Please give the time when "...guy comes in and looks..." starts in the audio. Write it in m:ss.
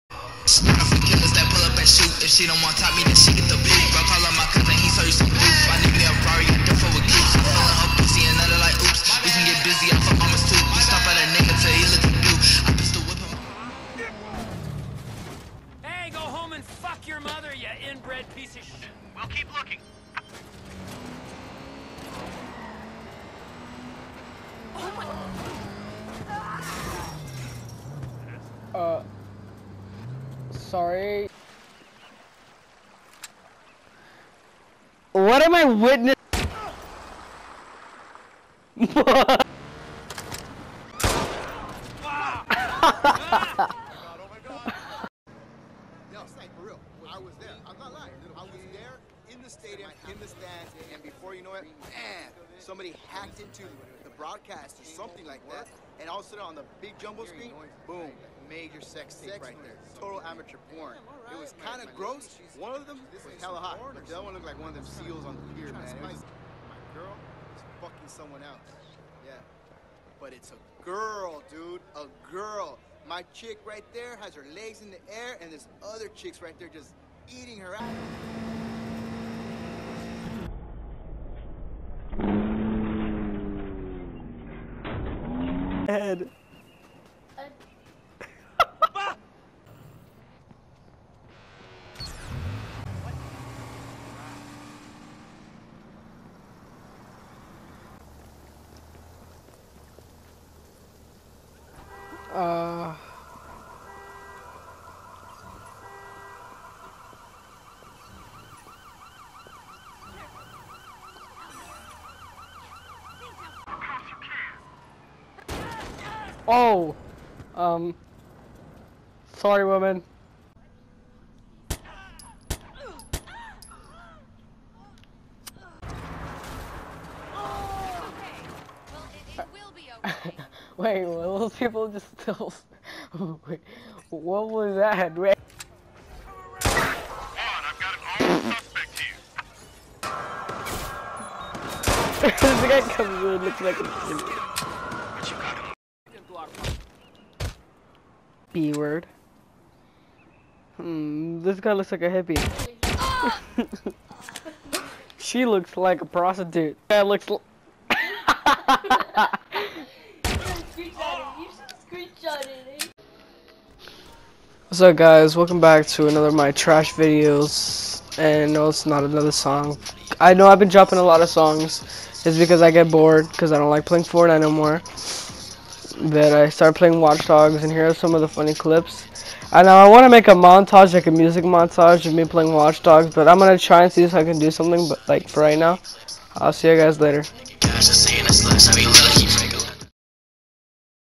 2:22.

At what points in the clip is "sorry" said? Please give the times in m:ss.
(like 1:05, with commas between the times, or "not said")
0:30, 1:59.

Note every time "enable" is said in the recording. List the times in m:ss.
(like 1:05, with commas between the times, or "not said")
not said.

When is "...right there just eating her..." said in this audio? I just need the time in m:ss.
1:16.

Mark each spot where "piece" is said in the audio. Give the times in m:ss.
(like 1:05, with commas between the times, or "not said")
0:18.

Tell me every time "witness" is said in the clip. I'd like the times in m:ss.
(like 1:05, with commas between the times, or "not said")
0:35.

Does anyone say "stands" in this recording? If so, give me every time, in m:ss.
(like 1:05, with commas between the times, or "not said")
0:50.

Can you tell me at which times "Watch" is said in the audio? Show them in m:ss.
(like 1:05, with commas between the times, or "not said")
2:57, 3:02.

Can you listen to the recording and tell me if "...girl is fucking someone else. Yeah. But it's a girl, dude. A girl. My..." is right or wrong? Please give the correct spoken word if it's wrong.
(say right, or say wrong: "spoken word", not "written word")
right.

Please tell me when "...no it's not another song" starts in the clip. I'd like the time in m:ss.
2:48.